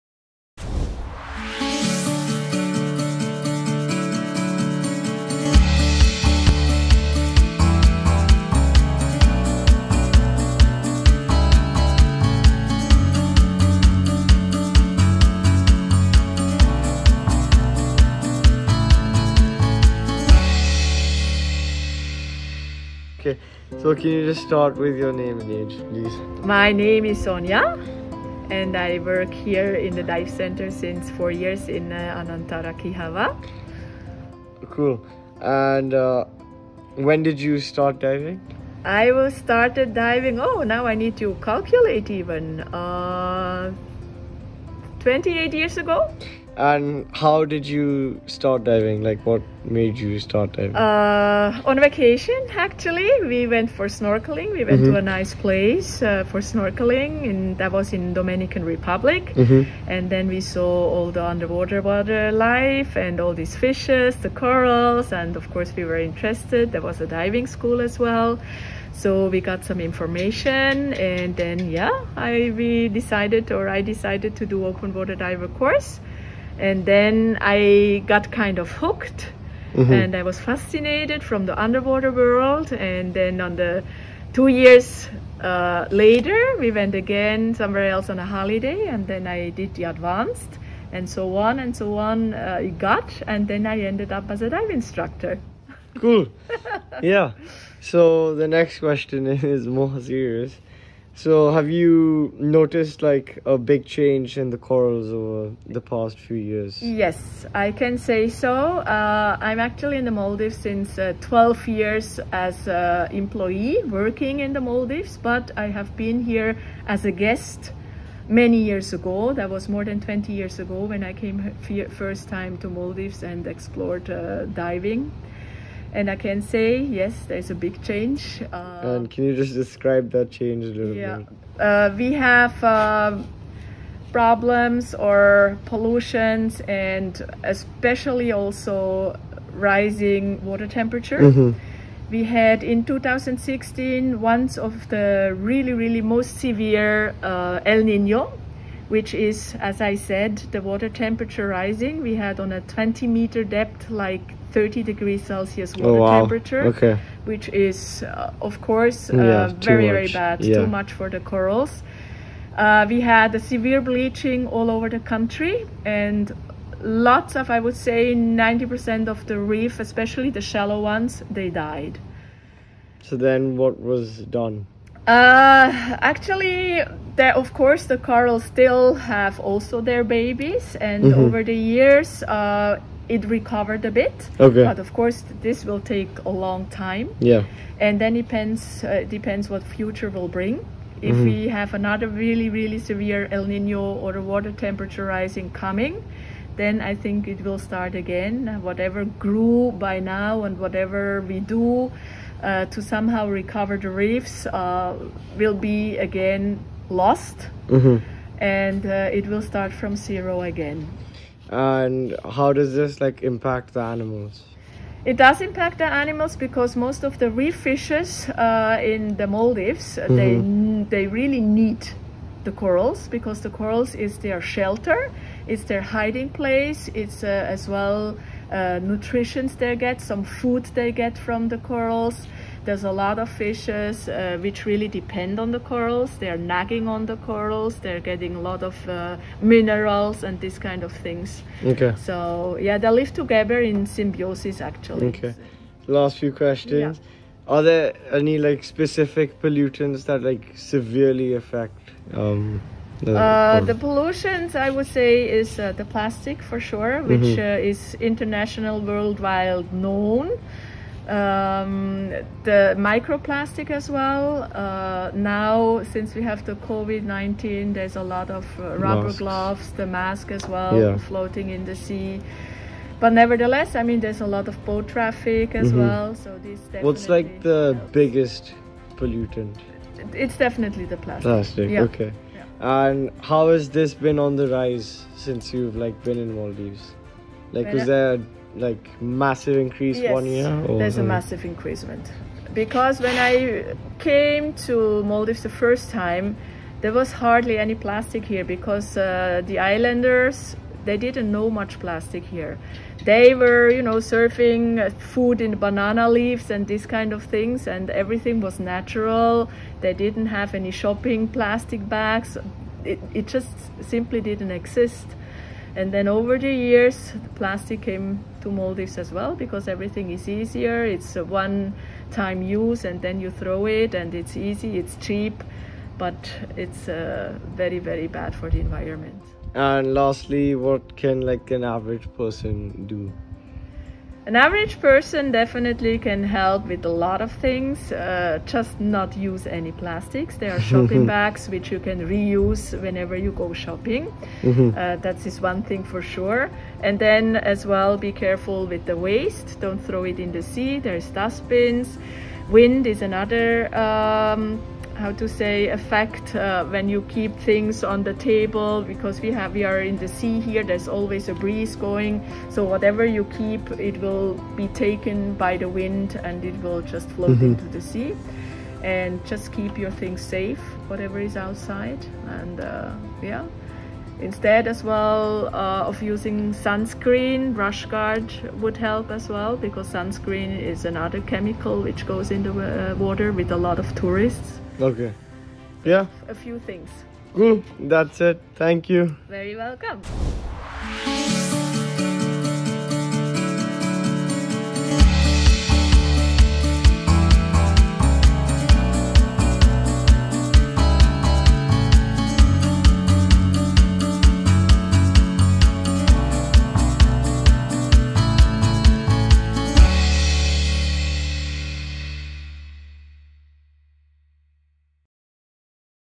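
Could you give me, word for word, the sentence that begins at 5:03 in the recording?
They were, you know, surfing uh, food in banana leaves and this kind of things, and everything was natural.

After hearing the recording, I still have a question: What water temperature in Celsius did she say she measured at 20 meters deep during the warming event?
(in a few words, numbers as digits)
30 degrees Celsius.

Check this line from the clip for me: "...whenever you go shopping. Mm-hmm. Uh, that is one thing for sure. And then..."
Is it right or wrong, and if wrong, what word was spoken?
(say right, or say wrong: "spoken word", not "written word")
right.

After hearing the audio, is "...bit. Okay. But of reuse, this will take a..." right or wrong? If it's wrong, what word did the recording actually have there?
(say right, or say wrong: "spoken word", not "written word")
wrong: "course", not "reuse".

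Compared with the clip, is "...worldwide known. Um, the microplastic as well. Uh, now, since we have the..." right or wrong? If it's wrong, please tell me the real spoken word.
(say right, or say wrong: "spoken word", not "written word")
right.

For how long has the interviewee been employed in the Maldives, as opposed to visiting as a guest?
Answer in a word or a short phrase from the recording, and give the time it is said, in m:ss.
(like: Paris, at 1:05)
12 years, at 1:51.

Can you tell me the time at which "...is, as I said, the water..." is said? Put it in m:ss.
2:29.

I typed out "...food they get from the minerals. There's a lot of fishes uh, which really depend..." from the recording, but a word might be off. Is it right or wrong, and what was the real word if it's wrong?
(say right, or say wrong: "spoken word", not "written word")
wrong: "corals", not "minerals".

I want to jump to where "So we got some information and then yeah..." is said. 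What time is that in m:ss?
1:08.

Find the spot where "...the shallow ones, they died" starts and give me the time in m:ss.
2:50.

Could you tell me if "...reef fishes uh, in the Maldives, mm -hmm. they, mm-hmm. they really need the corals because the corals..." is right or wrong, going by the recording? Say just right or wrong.
right.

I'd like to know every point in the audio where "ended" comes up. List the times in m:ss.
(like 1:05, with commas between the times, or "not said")
1:33.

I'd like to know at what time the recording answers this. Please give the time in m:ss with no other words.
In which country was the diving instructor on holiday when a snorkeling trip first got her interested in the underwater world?
0:58.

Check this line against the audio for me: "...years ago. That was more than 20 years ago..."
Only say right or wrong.
right.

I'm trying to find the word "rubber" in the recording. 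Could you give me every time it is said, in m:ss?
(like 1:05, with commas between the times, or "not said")
4:28.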